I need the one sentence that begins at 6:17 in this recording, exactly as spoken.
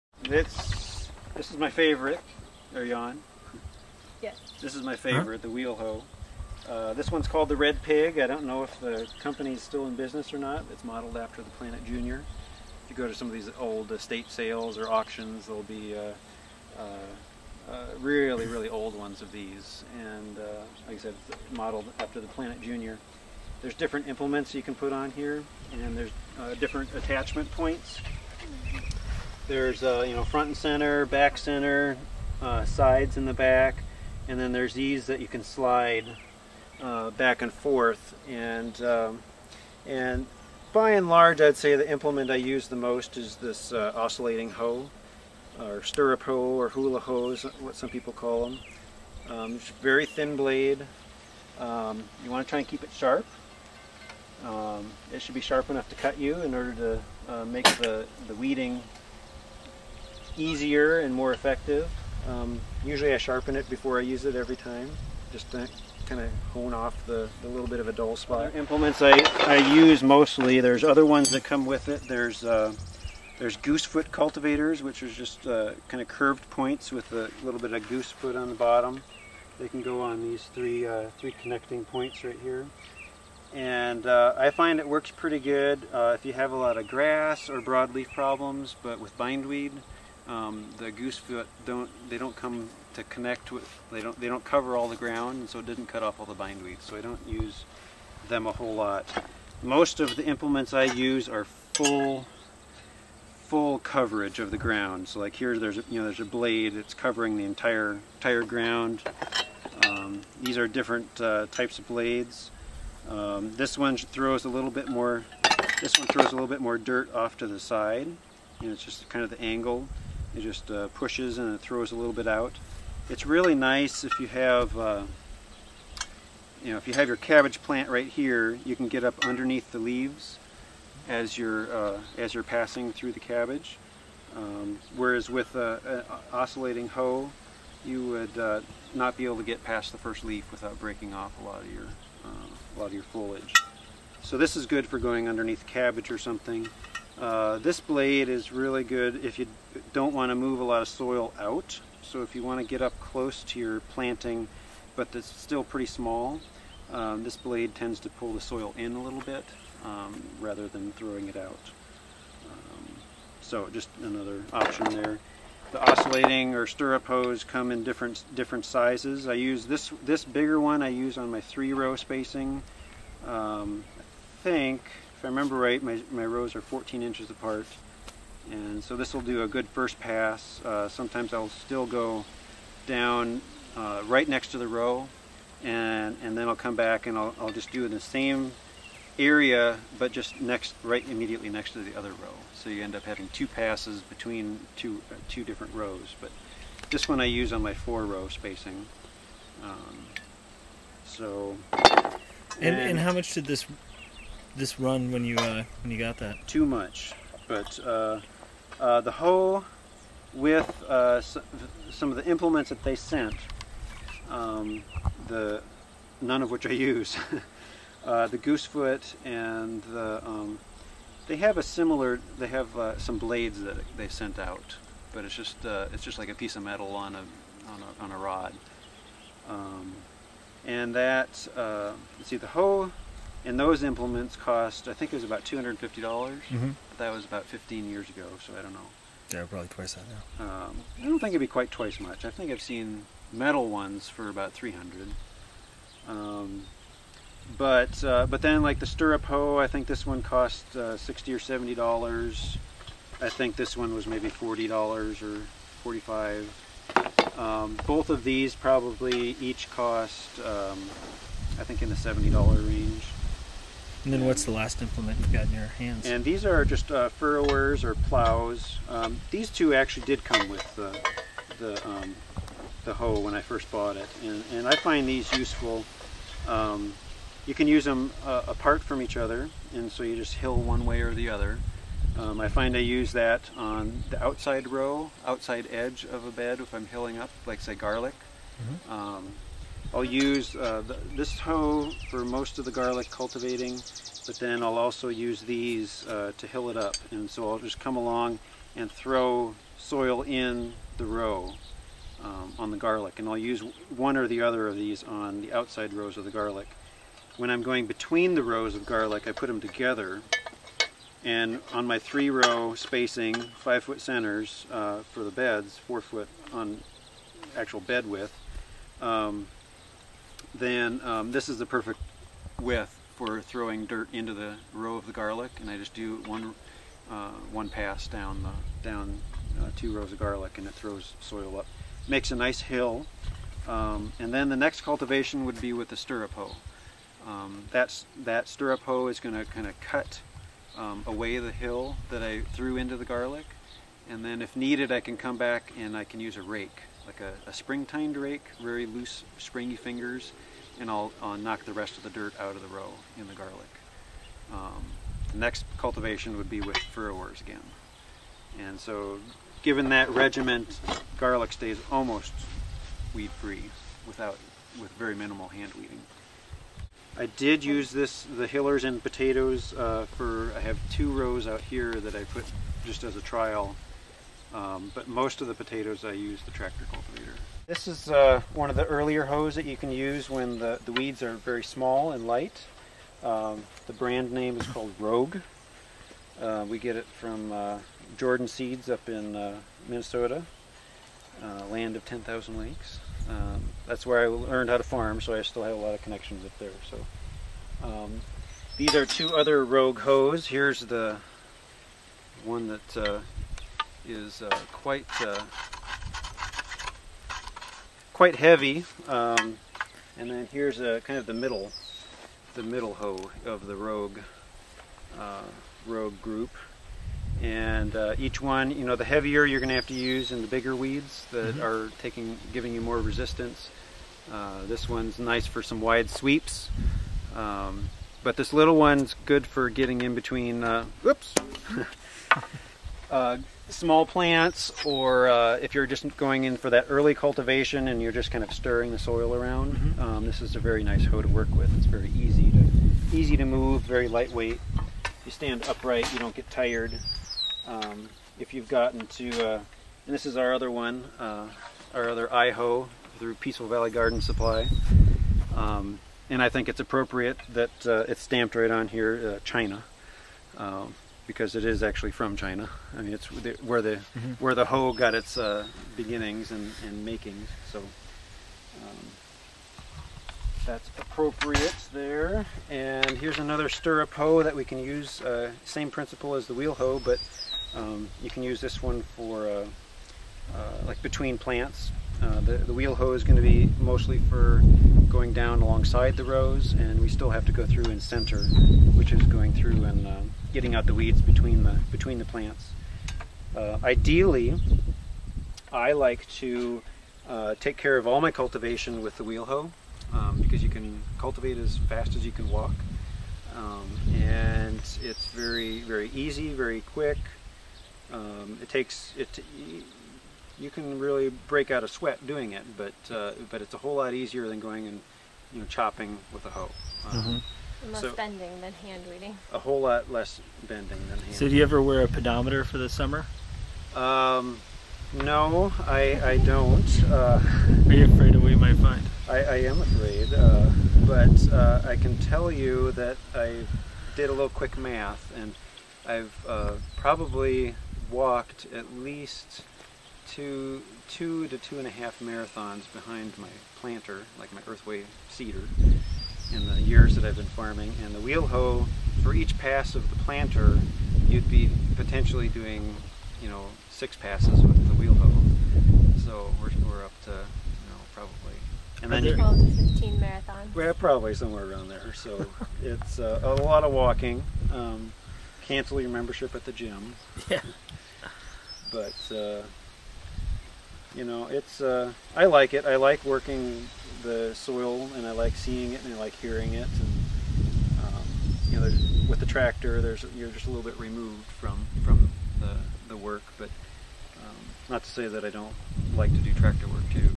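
This is uh, one of the earlier hoes that you can use when the, the weeds are very small and light.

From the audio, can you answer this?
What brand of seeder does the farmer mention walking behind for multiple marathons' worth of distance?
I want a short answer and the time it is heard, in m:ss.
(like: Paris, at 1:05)
Earthway, at 9:04.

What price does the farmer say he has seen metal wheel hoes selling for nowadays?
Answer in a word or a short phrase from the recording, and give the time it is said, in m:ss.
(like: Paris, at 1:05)
$300, at 4:04.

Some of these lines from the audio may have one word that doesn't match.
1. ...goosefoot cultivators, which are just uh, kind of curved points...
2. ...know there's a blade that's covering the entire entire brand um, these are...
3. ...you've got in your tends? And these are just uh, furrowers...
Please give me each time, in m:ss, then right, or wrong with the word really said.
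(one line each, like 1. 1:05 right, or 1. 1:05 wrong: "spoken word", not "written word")
1. 1:13 right
2. 1:45 wrong: "ground", not "brand"
3. 4:25 wrong: "hands", not "tends".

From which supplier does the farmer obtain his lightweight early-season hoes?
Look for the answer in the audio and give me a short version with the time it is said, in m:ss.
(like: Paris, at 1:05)
Jordan Seeds, at 6:28.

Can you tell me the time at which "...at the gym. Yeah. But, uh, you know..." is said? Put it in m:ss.
9:26.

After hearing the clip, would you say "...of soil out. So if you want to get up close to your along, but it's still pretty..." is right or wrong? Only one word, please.
wrong.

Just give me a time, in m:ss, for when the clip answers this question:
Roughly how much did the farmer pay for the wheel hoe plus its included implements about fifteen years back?
3:55.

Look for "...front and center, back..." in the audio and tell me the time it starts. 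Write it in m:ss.
0:30.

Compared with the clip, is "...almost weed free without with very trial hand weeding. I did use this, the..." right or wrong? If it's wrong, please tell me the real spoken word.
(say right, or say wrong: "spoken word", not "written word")
wrong: "minimal", not "trial".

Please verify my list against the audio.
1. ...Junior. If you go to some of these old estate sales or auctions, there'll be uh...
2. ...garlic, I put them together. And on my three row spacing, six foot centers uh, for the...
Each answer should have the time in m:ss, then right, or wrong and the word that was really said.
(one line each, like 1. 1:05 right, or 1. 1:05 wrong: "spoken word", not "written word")
1. 0:11 right
2. 5:08 wrong: "five", not "six".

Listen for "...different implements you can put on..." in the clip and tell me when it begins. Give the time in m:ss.
0:23.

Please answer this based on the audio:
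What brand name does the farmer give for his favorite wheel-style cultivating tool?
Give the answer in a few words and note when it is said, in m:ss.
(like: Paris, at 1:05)
Red Pig, at 0:07.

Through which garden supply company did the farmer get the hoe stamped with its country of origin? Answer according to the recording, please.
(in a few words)
Peaceful Valley Garden Supply.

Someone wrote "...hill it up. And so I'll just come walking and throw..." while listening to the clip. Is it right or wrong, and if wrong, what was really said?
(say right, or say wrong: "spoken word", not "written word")
wrong: "along", not "walking".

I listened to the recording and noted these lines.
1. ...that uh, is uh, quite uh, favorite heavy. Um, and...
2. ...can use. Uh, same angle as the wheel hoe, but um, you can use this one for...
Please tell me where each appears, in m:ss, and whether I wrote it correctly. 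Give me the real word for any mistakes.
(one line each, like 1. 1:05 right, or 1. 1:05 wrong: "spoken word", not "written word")
1. 6:42 wrong: "quite", not "favorite"
2. 7:54 wrong: "principle", not "angle".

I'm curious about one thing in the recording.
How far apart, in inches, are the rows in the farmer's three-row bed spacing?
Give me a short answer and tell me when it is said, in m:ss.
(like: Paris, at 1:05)
14 inches, at 2:56.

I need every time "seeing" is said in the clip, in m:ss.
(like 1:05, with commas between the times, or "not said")
9:35.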